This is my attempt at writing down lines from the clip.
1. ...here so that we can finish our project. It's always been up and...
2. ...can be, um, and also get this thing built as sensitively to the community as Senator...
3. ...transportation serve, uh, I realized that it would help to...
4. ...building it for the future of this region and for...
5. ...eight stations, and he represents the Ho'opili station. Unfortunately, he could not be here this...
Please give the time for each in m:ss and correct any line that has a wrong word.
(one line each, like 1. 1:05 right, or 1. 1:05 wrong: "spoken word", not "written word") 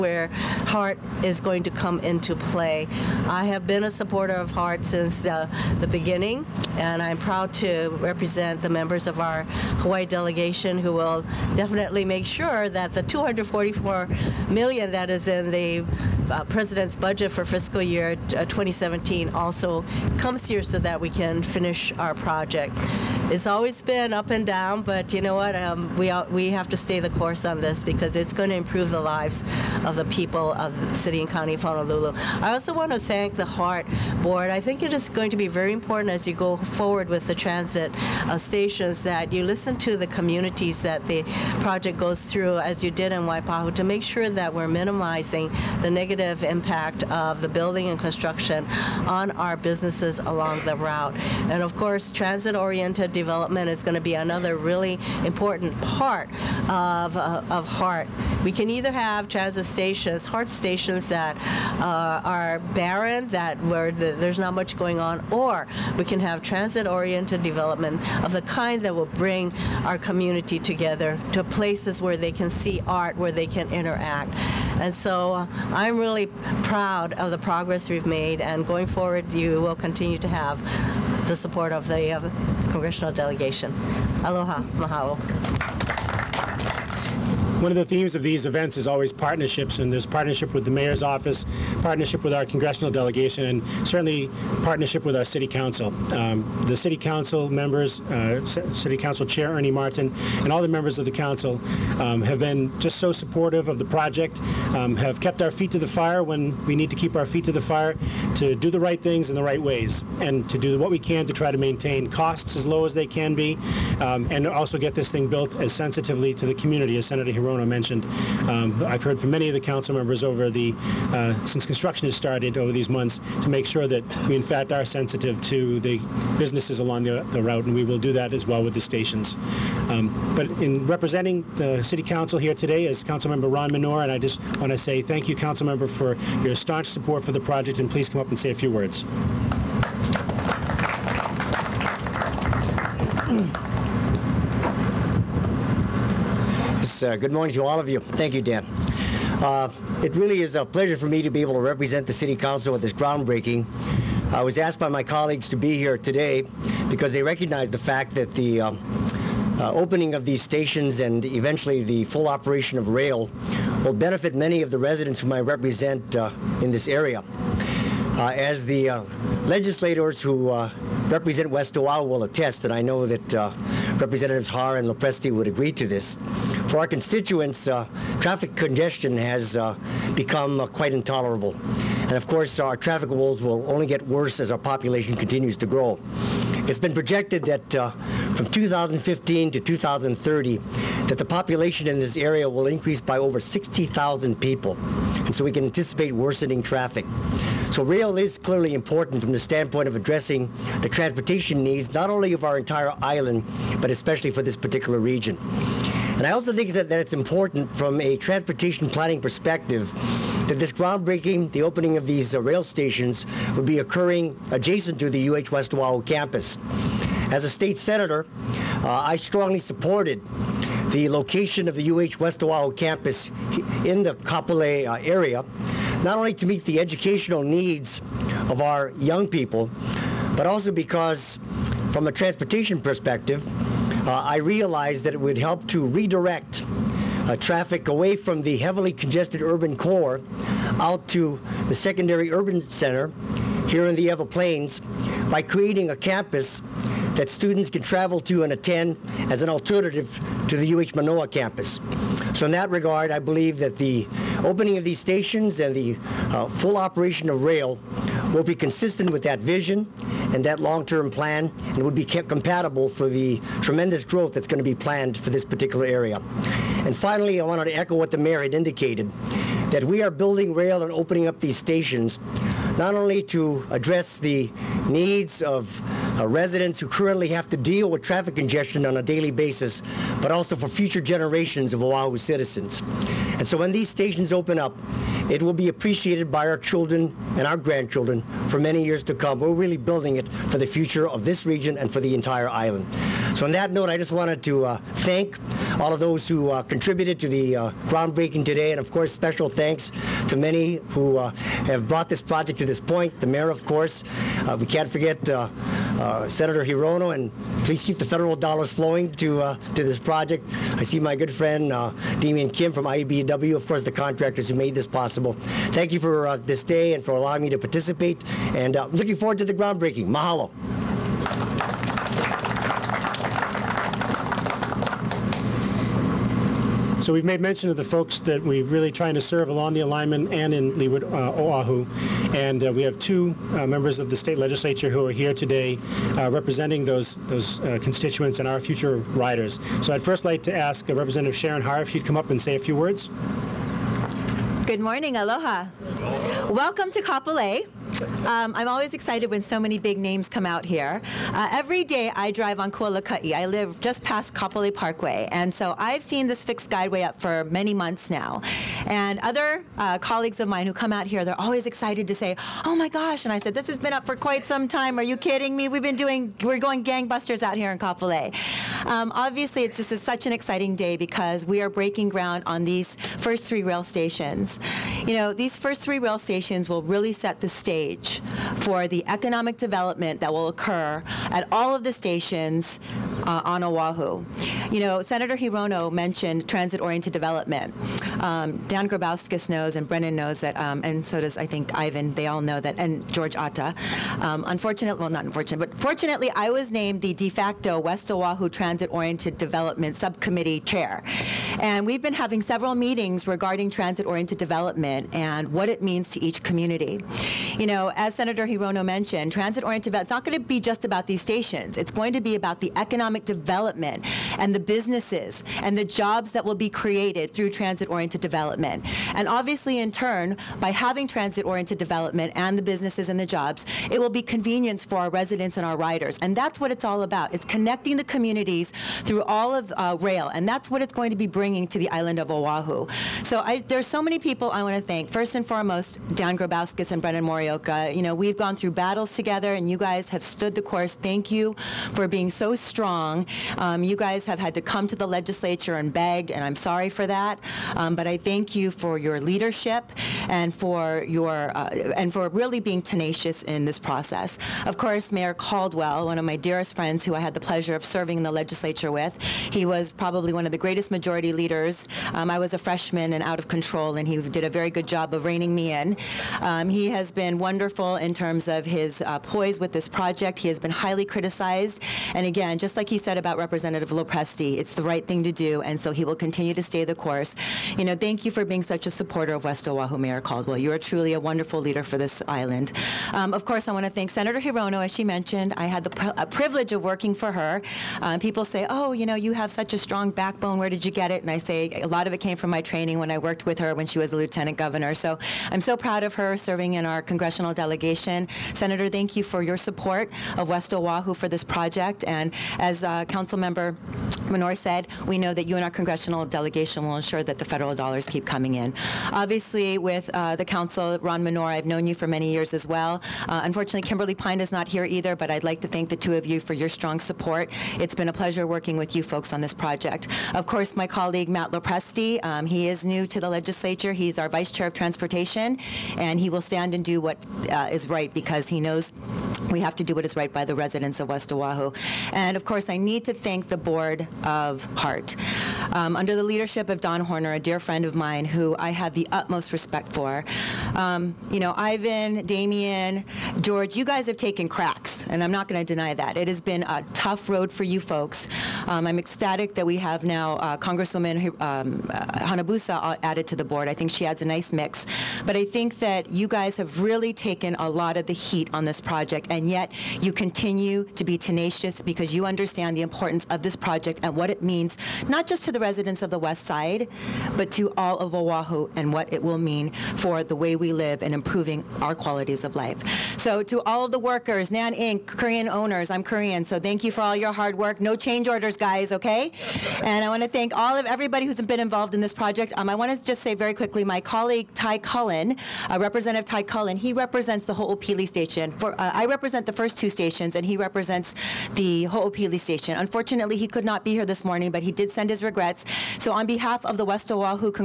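1. 0:20 right
2. 1:53 right
3. 3:52 wrong: "perspective", not "serve"
4. 4:49 right
5. 9:49 wrong: "two", not "eight".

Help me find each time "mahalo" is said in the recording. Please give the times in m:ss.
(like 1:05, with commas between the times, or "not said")
1:24, 5:20.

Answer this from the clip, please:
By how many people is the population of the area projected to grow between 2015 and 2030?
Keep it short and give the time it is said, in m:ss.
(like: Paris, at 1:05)
over 60,000, at 3:13.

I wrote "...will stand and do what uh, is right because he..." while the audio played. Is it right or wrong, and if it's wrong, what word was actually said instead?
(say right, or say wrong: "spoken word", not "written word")
right.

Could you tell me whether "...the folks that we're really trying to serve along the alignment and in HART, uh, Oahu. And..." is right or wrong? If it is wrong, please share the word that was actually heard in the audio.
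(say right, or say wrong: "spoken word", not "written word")
wrong: "Leeward", not "HART".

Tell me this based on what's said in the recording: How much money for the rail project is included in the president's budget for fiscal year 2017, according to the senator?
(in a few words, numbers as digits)
244 million.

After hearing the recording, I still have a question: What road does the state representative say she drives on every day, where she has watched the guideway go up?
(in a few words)
Kualaka'i.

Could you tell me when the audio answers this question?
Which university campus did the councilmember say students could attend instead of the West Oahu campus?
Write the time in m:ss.
4:10.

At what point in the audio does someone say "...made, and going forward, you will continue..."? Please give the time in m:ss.
1:18.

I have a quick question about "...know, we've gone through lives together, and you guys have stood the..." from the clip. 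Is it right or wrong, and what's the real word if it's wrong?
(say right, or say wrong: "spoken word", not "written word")
wrong: "battles", not "lives".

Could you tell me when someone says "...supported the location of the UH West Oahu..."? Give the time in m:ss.
3:39.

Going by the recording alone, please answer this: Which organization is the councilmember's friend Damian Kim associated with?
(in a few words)
IBW.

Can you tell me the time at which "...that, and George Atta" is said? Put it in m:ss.
6:32.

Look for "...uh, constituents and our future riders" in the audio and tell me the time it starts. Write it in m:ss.
5:37.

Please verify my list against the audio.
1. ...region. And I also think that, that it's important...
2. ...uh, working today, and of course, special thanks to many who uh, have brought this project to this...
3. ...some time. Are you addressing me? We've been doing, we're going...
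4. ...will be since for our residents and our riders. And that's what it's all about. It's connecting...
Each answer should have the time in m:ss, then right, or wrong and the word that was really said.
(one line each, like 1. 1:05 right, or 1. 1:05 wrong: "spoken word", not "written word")
1. 3:24 right
2. 4:57 wrong: "groundbreaking", not "working"
3. 6:04 wrong: "kidding", not "addressing"
4. 7:04 wrong: "convenience", not "since".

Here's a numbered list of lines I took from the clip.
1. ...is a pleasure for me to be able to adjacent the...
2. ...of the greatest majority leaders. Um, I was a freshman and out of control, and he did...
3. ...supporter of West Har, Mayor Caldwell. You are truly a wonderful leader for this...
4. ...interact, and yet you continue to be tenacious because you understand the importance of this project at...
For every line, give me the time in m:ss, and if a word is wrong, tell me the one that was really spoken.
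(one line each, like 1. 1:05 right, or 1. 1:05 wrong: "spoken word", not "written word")
1. 2:30 wrong: "represent", not "adjacent"
2. 7:40 right
3. 7:58 wrong: "Oahu", not "Har"
4. 9:18 wrong: "project", not "interact".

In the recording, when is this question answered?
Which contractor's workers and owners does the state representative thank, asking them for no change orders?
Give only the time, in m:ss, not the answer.
9:34.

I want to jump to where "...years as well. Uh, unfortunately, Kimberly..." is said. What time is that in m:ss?
8:32.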